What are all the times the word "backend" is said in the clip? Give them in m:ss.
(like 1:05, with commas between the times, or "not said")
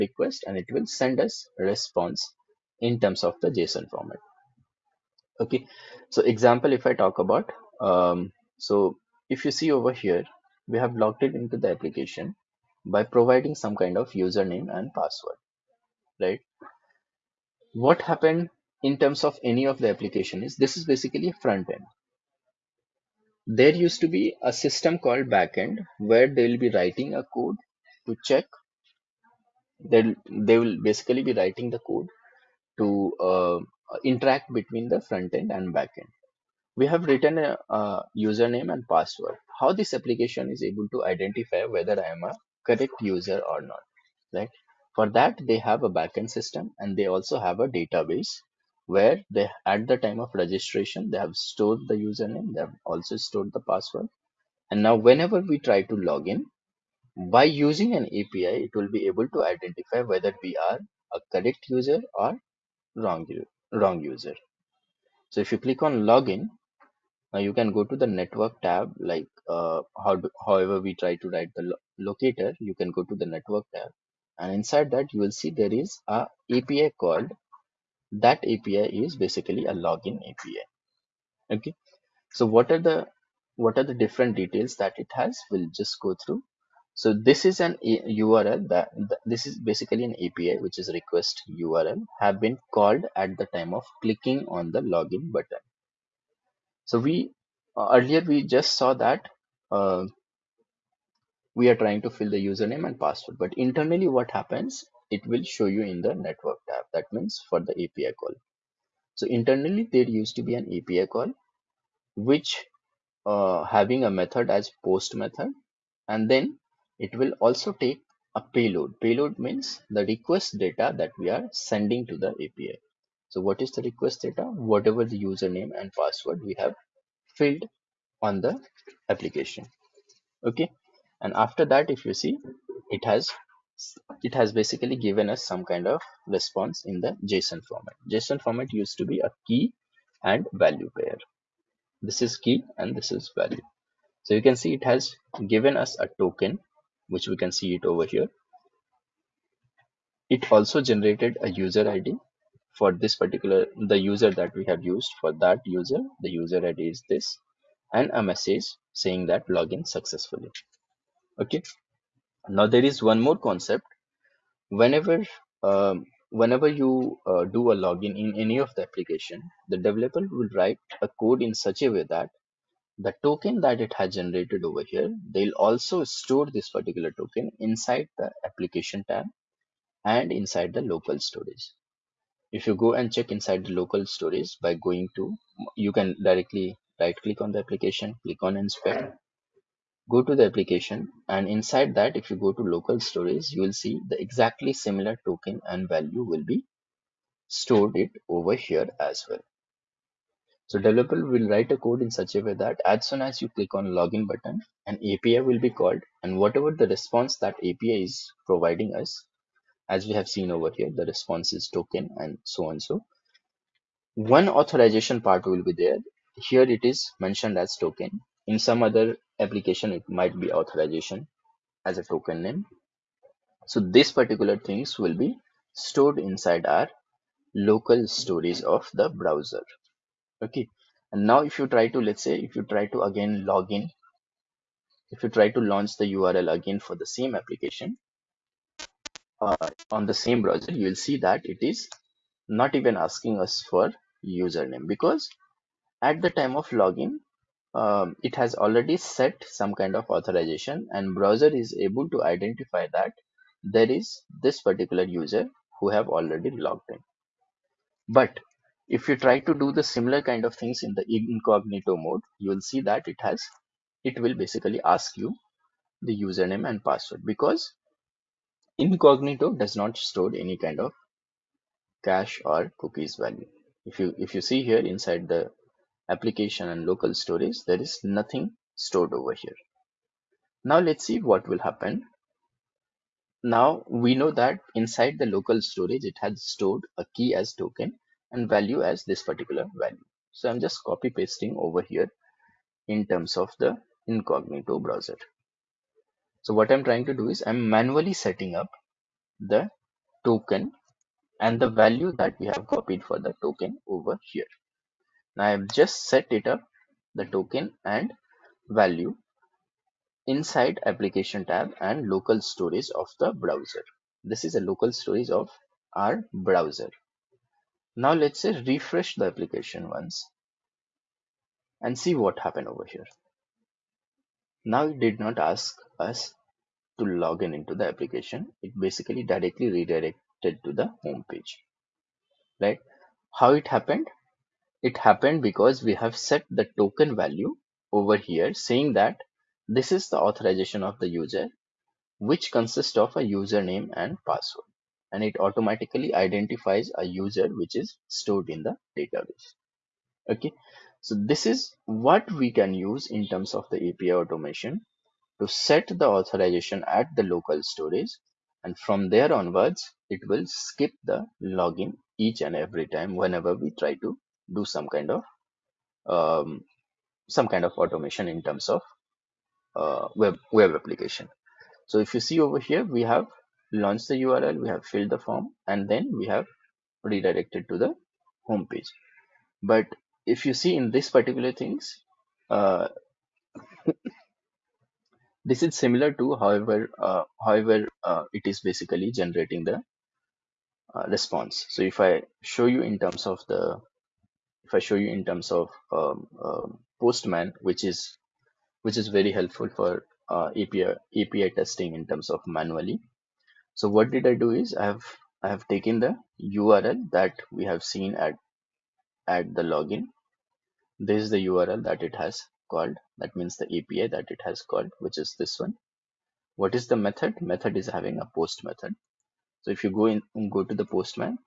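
0:25, 0:35, 0:45.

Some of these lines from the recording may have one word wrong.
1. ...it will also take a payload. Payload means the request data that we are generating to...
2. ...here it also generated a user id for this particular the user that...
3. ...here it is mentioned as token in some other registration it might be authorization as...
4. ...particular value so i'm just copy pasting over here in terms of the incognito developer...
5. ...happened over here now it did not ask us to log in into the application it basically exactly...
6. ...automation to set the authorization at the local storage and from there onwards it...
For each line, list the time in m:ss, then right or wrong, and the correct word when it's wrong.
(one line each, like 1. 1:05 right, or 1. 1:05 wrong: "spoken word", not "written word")
1. 1:56 wrong: "sending", not "generating"
2. 2:28 right
3. 3:36 wrong: "application", not "registration"
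4. 4:49 wrong: "browser", not "developer"
5. 5:22 wrong: "directly", not "exactly"
6. 5:54 right.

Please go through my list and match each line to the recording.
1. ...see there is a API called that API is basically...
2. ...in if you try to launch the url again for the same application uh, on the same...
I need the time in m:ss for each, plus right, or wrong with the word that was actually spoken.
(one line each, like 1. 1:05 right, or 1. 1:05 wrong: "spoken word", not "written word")
1. 1:15 right
2. 3:53 right.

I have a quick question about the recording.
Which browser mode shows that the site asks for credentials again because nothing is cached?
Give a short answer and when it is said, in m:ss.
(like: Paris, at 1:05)
Incognito mode, at 4:21.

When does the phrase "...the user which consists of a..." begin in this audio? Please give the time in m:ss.
5:40.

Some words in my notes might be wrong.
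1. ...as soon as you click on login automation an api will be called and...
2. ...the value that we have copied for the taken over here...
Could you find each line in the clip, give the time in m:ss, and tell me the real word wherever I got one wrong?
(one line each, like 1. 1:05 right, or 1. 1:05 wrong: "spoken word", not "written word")
1. 3:22 wrong: "button", not "automation"
2. 5:01 wrong: "token", not "taken".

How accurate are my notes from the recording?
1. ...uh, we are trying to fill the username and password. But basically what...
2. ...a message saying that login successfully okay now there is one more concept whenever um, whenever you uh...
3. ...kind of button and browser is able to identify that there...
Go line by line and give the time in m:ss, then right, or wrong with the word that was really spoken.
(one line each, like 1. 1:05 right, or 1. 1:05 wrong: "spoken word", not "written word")
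1. 1:39 wrong: "internally", not "basically"
2. 2:38 right
3. 4:09 wrong: "authorization", not "button".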